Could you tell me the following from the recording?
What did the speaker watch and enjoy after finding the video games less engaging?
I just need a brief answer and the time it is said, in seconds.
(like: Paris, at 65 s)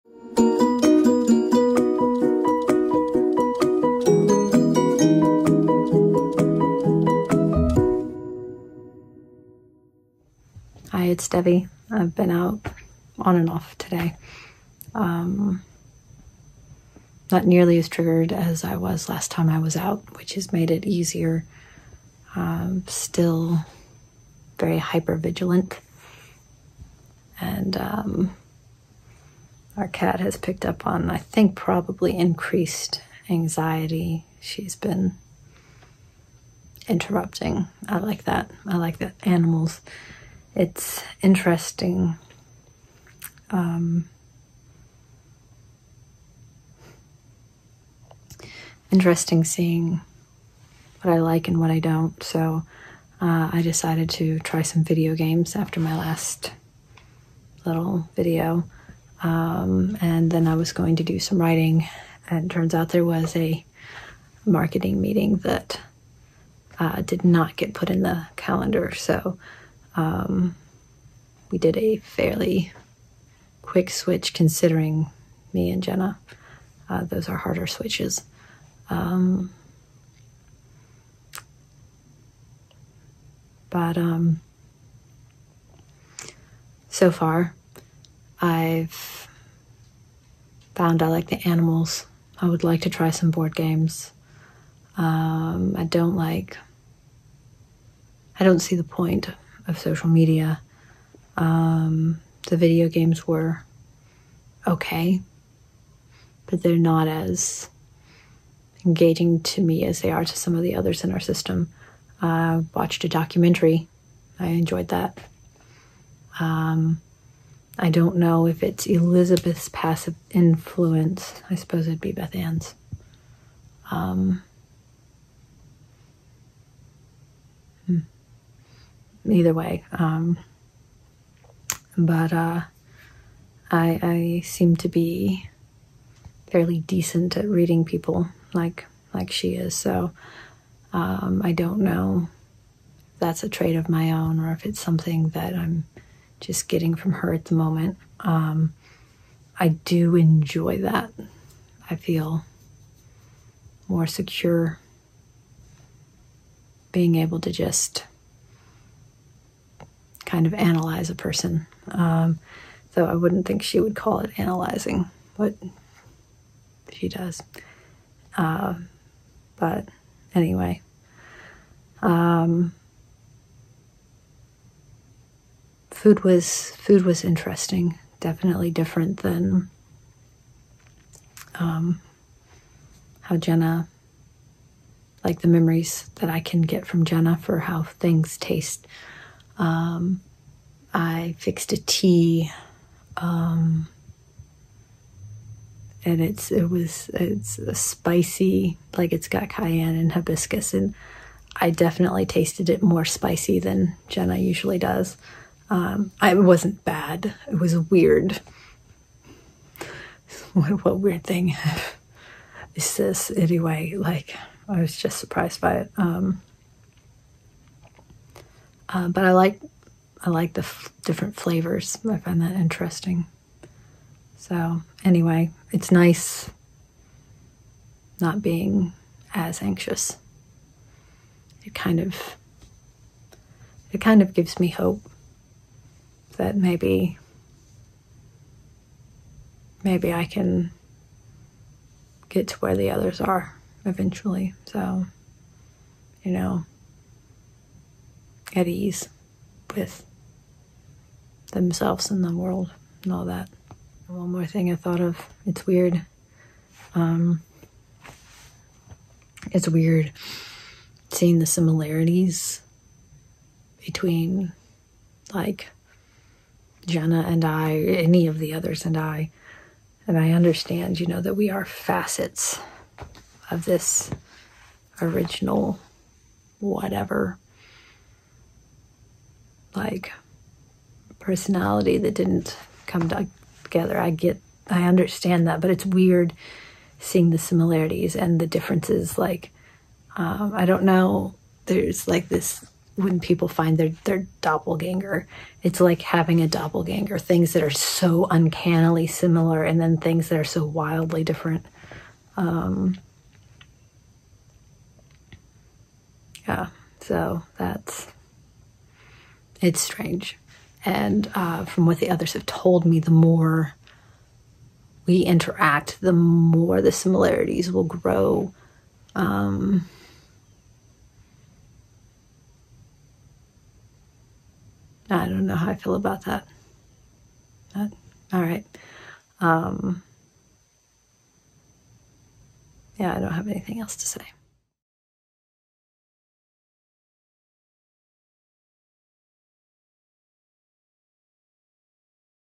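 A documentary, at 113 s.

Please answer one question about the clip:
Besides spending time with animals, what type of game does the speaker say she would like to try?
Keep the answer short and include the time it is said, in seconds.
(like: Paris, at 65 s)
Board games, at 93 s.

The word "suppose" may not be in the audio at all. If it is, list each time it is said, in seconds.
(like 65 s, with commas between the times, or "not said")
121 s.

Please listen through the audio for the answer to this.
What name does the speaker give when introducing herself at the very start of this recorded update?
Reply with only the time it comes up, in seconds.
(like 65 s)
11 s.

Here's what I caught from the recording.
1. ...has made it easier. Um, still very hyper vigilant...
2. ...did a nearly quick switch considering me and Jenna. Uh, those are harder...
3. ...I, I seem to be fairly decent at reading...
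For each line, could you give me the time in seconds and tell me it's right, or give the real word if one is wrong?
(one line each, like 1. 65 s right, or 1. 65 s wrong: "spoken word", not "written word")
1. 20 s right
2. 71 s wrong: "fairly", not "nearly"
3. 133 s right.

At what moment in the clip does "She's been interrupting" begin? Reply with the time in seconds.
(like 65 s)
34 s.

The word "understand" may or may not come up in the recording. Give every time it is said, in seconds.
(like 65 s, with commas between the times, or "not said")
270 s, 284 s.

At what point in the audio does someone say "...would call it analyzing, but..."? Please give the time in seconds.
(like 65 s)
163 s.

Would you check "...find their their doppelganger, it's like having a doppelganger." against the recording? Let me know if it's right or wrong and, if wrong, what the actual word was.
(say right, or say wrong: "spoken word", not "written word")
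right.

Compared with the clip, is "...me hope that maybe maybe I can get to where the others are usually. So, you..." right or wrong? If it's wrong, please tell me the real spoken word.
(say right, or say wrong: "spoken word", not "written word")
wrong: "eventually", not "usually".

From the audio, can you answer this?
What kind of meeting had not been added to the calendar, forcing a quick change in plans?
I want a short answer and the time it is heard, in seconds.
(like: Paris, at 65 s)
Marketing meeting, at 64 s.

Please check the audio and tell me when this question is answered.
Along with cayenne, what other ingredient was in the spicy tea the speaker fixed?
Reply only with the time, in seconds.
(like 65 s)
200 s.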